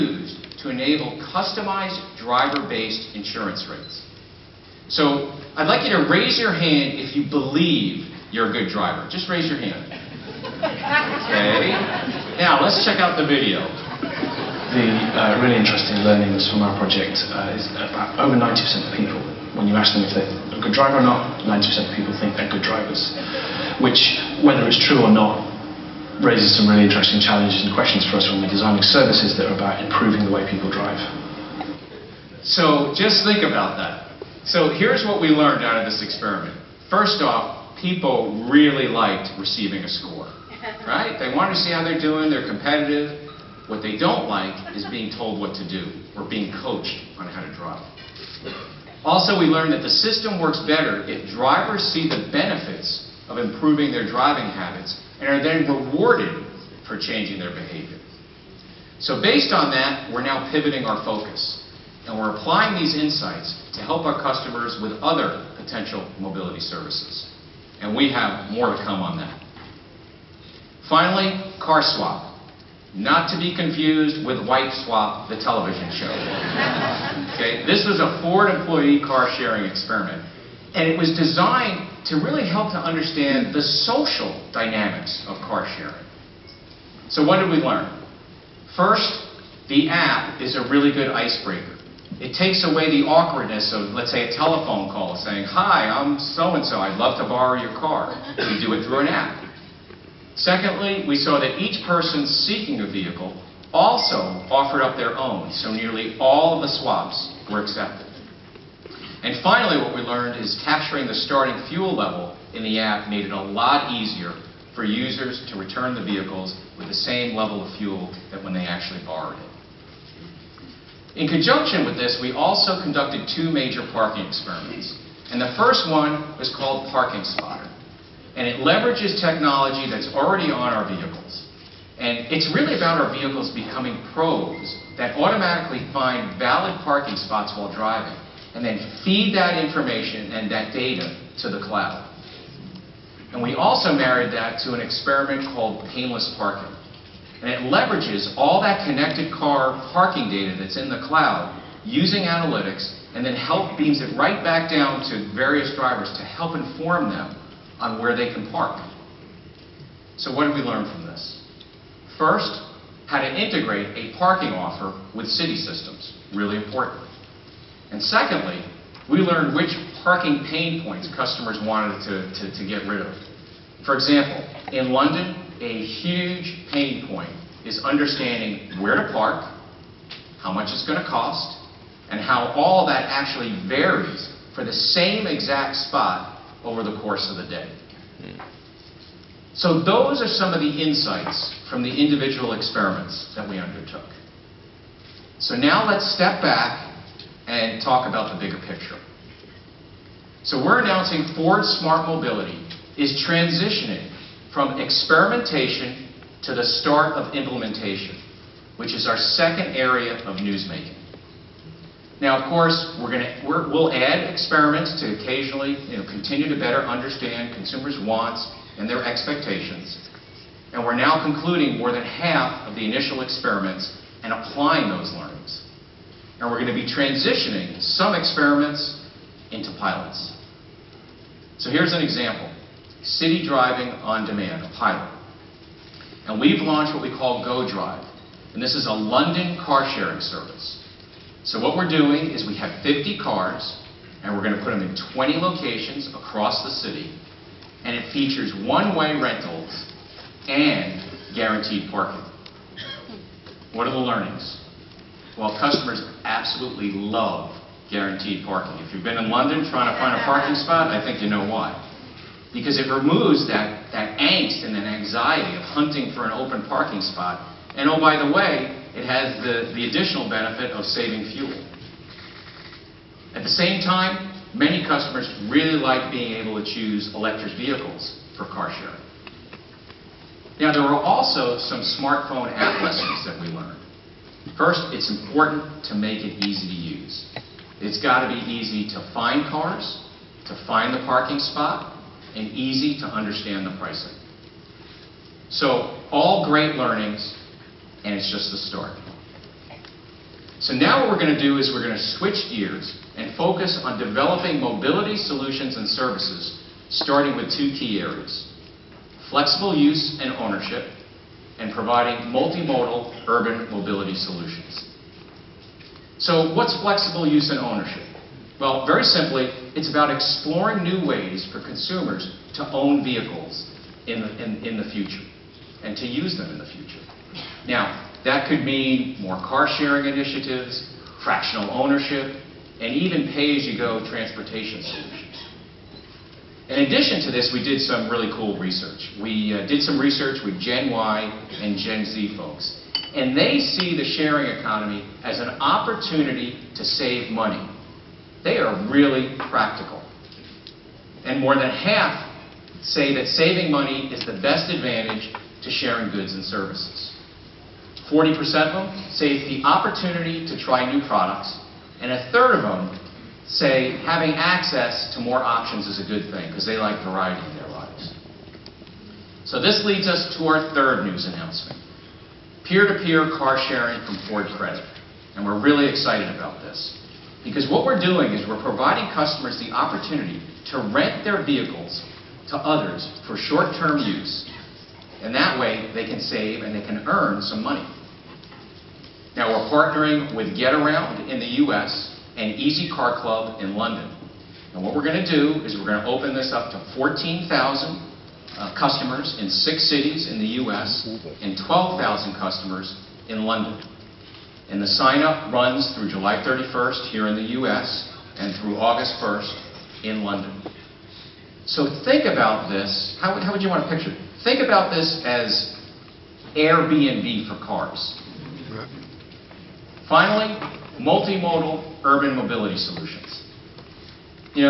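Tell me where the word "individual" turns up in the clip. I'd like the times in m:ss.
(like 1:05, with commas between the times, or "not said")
3:11.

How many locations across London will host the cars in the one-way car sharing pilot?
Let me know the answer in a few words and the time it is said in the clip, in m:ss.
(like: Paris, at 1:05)
20, at 4:05.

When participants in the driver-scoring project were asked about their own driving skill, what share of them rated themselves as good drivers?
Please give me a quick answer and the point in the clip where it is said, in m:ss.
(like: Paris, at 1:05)
over 90%, at 0:18.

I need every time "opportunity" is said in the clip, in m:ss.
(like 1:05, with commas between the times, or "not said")
5:45, 5:59, 6:19.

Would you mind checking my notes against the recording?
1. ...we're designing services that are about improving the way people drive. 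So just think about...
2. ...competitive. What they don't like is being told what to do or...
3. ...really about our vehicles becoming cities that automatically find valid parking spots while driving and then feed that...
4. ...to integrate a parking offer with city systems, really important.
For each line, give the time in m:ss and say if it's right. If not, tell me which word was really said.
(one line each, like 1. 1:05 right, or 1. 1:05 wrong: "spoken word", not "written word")
1. 0:28 right
2. 0:42 right
3. 2:12 wrong: "probes", not "cities"
4. 2:43 right.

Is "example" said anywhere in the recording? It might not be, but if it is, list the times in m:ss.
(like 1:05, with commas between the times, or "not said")
2:53, 3:52.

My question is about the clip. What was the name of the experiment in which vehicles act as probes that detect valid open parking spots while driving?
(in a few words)
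Parking Spotter.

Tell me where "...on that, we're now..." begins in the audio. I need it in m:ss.
0:59.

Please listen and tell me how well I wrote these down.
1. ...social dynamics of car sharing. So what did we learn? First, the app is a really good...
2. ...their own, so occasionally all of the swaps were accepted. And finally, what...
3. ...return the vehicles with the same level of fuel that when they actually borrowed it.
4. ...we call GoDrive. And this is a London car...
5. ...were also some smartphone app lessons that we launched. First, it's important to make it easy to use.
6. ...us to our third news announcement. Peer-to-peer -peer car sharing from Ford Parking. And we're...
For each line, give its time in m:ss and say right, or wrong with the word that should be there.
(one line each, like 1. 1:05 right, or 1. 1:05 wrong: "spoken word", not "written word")
1. 1:23 right
2. 1:44 wrong: "nearly", not "occasionally"
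3. 1:55 right
4. 3:57 right
5. 4:40 wrong: "learned", not "launched"
6. 6:10 wrong: "Credit", not "Parking".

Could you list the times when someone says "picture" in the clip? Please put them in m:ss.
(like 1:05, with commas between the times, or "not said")
3:18, 6:53.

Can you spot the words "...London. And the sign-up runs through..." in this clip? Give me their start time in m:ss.
6:43.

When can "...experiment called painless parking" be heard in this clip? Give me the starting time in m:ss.
2:24.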